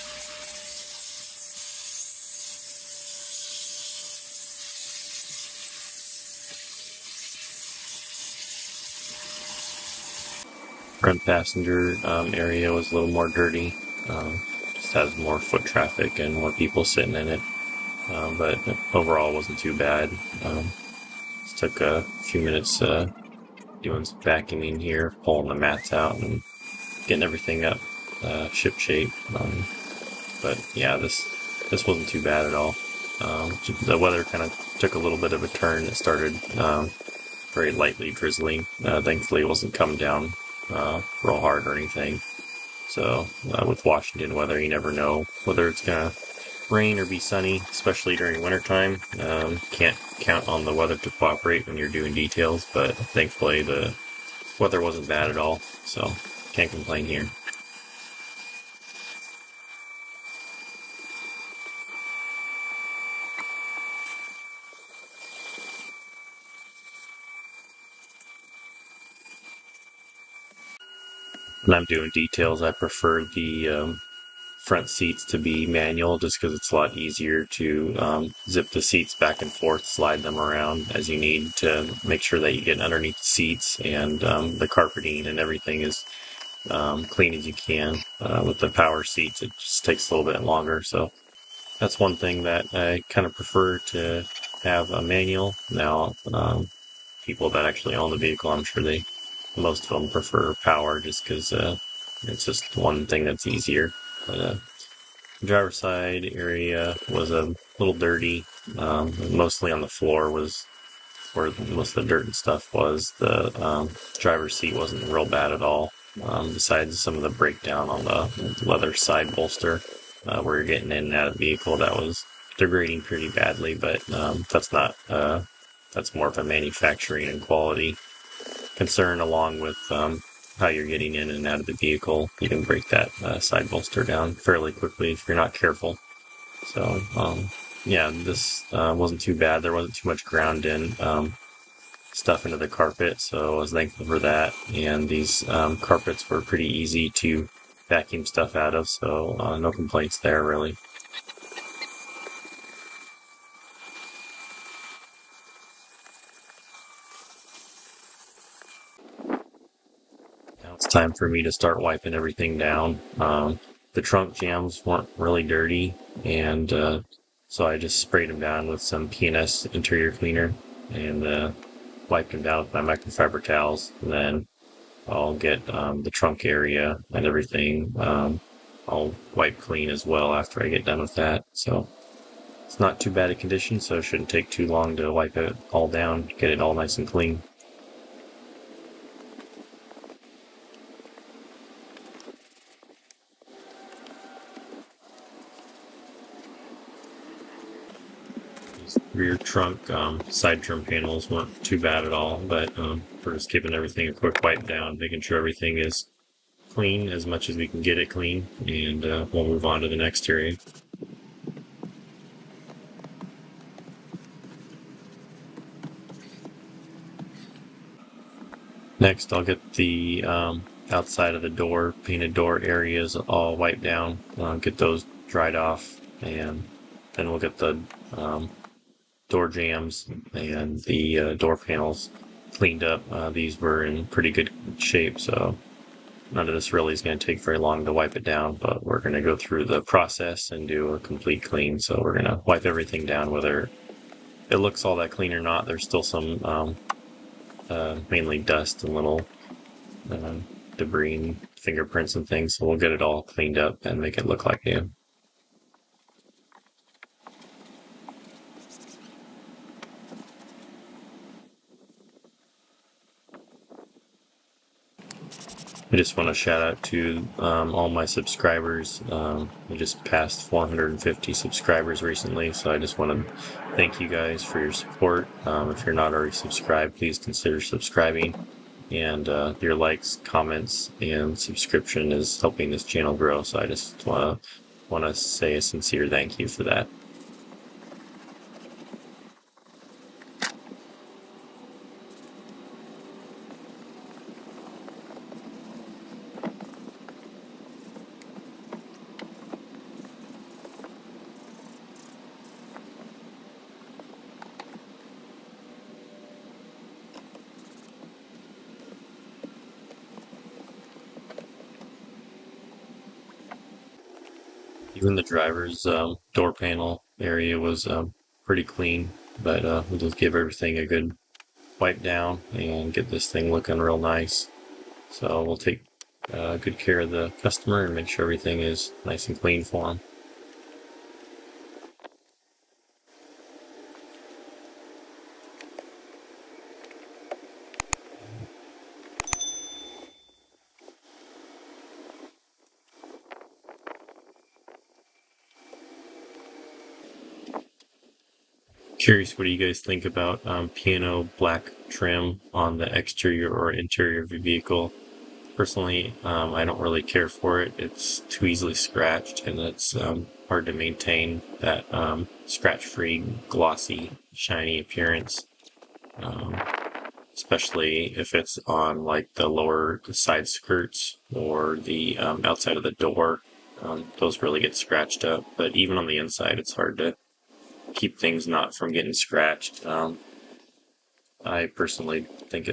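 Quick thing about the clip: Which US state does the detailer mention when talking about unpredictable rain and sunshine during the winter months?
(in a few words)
Washington.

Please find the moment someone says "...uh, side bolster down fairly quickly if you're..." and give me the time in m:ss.
2:13.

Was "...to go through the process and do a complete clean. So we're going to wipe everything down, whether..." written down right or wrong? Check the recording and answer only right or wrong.
right.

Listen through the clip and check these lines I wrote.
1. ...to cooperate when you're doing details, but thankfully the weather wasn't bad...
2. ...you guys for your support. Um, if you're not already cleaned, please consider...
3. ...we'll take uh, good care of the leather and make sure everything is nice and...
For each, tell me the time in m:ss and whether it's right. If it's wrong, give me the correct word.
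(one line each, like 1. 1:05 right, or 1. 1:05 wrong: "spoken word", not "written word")
1. 0:50 right
2. 4:33 wrong: "subscribed", not "cleaned"
3. 5:25 wrong: "customer", not "leather".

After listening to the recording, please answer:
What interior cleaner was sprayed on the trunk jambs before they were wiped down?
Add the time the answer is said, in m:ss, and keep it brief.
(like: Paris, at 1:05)
P&S, at 2:49.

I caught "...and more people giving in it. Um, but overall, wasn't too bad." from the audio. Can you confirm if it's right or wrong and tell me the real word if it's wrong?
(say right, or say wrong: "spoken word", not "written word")
wrong: "sitting", not "giving".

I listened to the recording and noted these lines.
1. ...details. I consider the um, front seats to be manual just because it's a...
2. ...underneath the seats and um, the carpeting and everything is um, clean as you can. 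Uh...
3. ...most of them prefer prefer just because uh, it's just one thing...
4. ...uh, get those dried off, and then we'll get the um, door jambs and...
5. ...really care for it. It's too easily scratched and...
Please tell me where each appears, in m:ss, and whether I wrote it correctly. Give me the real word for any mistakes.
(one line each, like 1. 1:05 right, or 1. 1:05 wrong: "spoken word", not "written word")
1. 1:12 wrong: "prefer", not "consider"
2. 1:22 right
3. 1:39 wrong: "power", not "prefer"
4. 3:44 right
5. 5:56 right.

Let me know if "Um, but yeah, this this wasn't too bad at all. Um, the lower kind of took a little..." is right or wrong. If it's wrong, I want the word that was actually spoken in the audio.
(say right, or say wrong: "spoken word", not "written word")
wrong: "weather", not "lower".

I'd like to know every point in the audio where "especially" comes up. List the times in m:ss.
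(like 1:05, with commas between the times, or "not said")
0:47, 6:07.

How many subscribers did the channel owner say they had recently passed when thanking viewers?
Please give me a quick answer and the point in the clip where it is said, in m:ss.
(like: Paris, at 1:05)
450, at 4:30.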